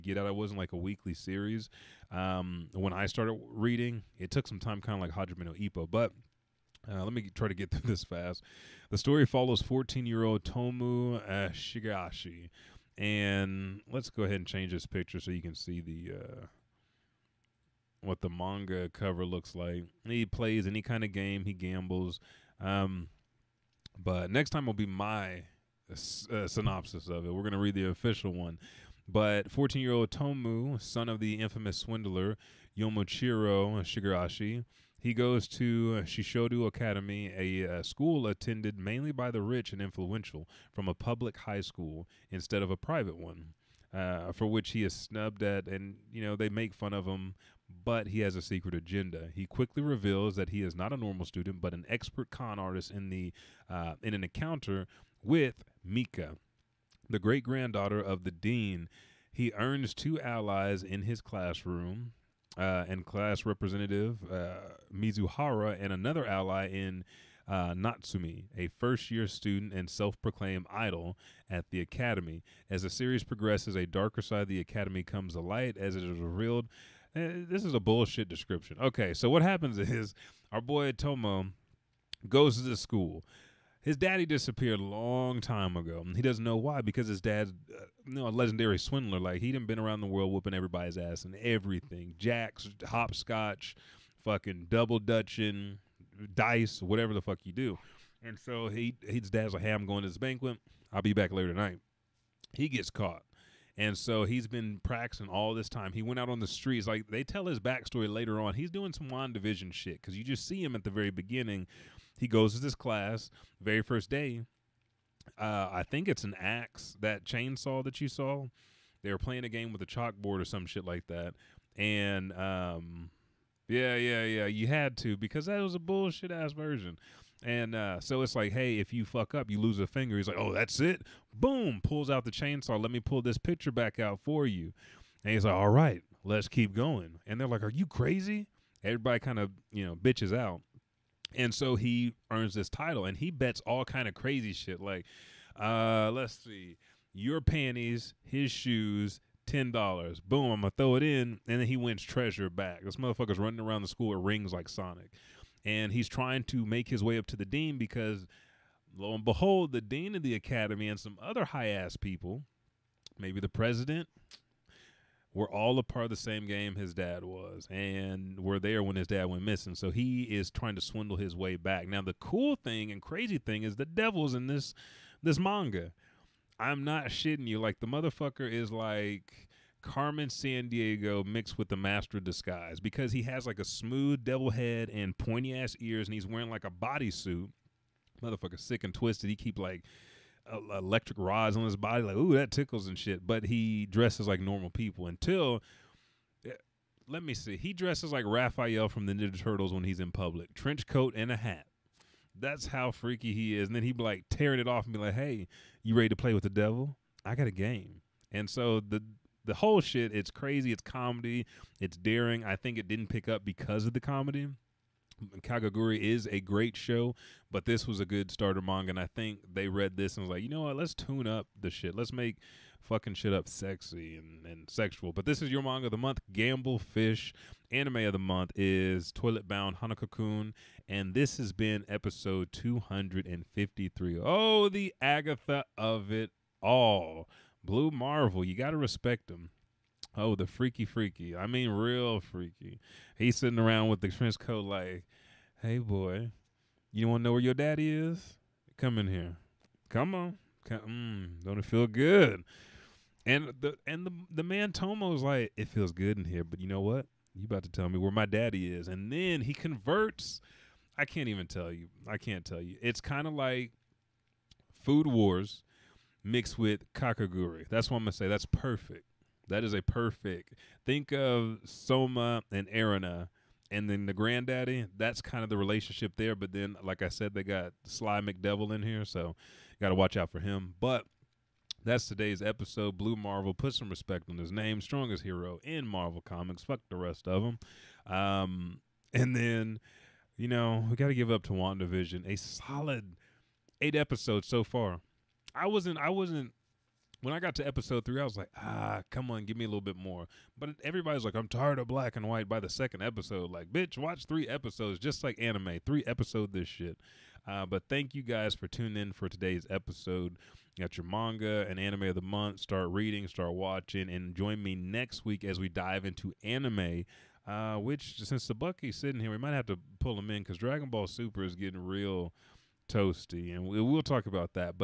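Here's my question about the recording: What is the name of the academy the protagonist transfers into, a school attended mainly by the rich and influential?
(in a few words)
Shishodo Academy.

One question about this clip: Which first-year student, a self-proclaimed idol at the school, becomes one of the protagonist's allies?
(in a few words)
Natsumi.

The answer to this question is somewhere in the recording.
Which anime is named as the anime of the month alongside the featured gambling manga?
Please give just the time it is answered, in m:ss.
3:49.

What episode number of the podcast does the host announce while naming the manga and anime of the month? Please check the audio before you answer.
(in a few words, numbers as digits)
253.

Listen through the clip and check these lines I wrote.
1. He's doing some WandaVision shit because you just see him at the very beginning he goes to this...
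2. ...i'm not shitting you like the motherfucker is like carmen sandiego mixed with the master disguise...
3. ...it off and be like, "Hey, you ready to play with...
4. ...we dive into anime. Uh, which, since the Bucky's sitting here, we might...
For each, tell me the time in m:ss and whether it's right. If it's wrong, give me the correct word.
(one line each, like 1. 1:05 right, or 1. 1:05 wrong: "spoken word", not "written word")
1. 1:48 right
2. 2:56 right
3. 3:24 right
4. 5:15 right.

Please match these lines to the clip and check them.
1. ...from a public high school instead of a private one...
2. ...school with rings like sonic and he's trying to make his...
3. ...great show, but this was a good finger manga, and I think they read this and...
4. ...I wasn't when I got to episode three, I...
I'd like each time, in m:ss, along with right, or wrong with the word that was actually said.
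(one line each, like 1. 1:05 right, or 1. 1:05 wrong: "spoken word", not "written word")
1. 0:40 right
2. 2:33 right
3. 3:36 wrong: "starter", not "finger"
4. 4:55 right.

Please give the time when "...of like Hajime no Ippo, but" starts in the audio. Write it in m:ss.
0:05.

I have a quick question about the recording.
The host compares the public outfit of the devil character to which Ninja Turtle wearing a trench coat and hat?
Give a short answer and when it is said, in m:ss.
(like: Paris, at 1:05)
Raphael, at 3:18.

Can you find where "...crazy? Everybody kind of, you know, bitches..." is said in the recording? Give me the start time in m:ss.
2:17.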